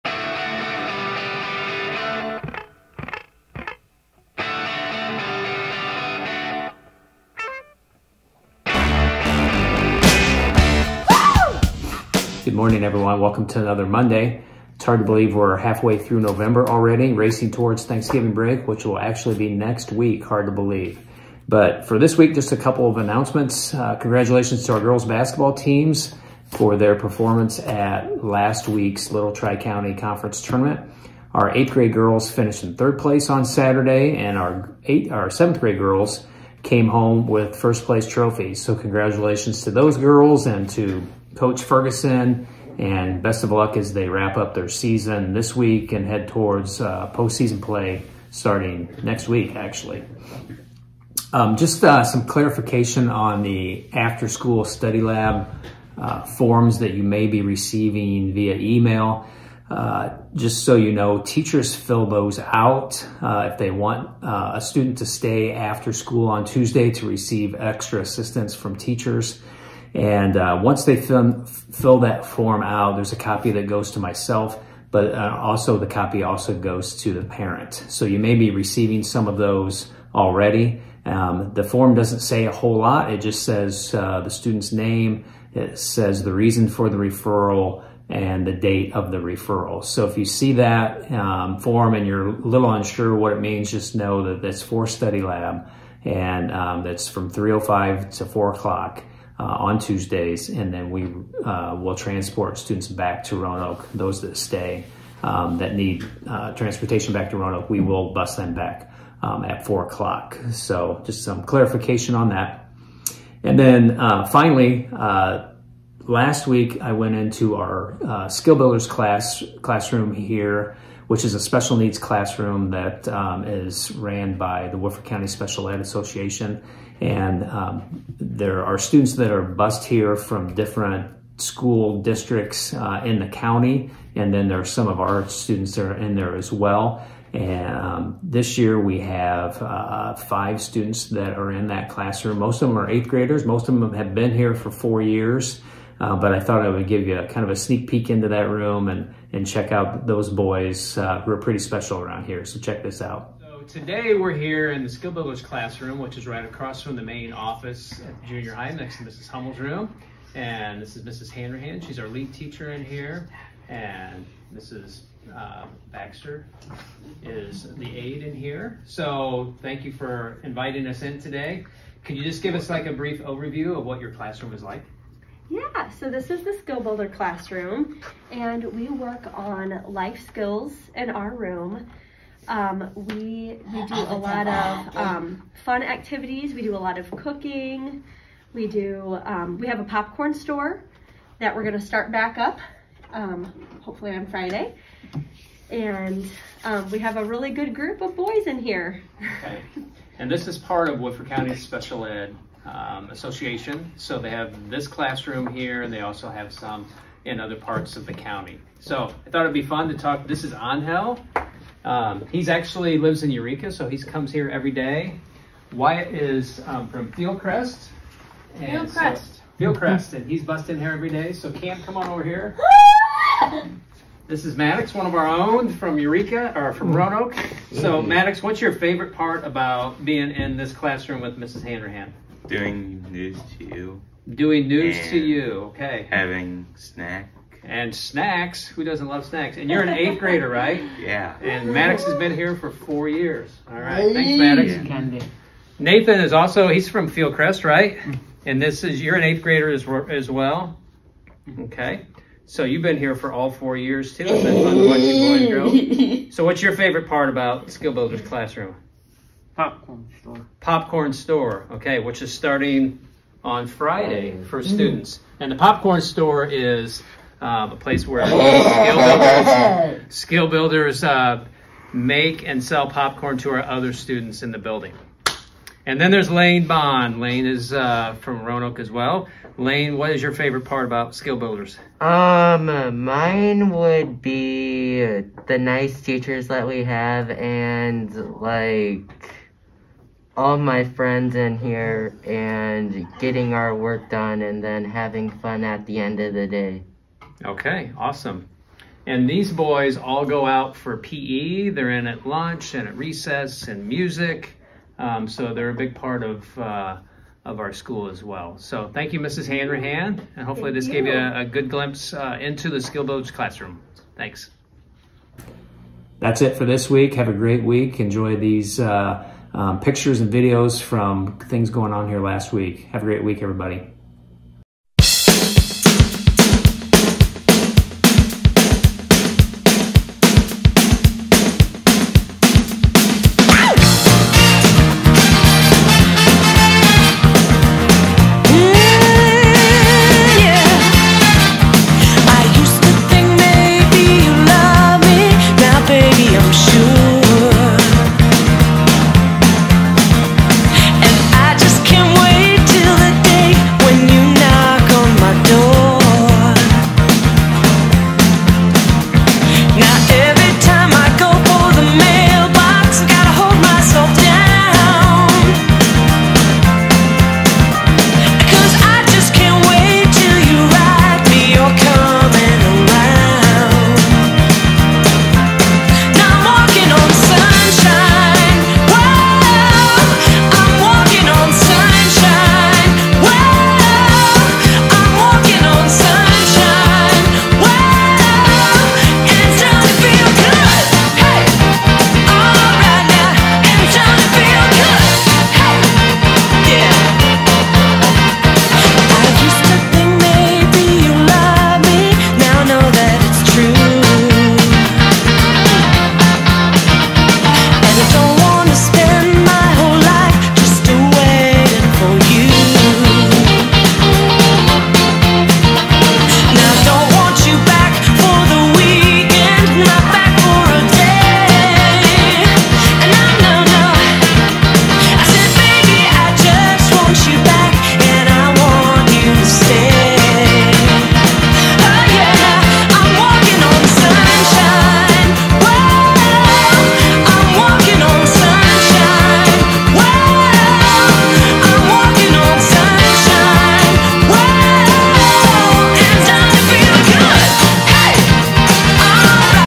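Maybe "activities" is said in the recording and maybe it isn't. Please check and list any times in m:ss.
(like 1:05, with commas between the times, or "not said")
3:05.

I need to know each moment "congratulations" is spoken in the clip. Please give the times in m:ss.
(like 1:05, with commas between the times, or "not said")
0:23, 0:38.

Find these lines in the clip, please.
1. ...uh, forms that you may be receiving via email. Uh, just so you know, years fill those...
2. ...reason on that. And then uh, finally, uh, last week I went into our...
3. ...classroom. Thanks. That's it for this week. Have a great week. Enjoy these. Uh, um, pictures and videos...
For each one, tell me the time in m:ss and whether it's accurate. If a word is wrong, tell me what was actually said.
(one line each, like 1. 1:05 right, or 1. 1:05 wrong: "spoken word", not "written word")
1. 0:55 wrong: "teachers", not "years"
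2. 1:51 wrong: "clarification", not "reason"
3. 5:13 right.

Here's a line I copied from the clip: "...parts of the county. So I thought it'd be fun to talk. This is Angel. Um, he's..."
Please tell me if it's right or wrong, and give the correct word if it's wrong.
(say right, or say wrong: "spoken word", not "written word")
right.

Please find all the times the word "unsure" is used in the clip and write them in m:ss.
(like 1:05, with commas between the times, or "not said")
1:32.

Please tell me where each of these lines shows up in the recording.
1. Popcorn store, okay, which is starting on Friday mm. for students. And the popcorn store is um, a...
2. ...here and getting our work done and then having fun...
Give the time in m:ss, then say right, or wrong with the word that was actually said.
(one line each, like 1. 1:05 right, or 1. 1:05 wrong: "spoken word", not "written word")
1. 4:20 right
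2. 4:51 right.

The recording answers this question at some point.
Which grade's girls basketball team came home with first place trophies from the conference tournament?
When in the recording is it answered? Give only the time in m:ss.
0:35.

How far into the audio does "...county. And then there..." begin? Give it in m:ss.
2:13.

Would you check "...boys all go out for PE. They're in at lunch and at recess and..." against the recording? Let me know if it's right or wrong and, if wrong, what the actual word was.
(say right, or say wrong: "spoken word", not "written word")
right.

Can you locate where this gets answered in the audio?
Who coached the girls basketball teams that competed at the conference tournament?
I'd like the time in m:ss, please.
0:41.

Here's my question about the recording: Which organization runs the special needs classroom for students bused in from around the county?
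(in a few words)
Woodford County Special Ed Association.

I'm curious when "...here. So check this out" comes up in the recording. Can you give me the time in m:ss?
2:32.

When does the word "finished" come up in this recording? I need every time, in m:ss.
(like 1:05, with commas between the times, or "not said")
0:32.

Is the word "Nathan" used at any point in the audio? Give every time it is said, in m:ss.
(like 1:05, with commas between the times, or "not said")
4:05.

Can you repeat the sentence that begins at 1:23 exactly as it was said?
It just says uh, the student's name, it says the reason for the referral, and the date of the referral.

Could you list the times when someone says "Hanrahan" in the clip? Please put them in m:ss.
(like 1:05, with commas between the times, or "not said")
2:41, 3:51, 5:09.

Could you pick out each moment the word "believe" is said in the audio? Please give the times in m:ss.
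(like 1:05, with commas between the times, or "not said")
0:15, 0:20.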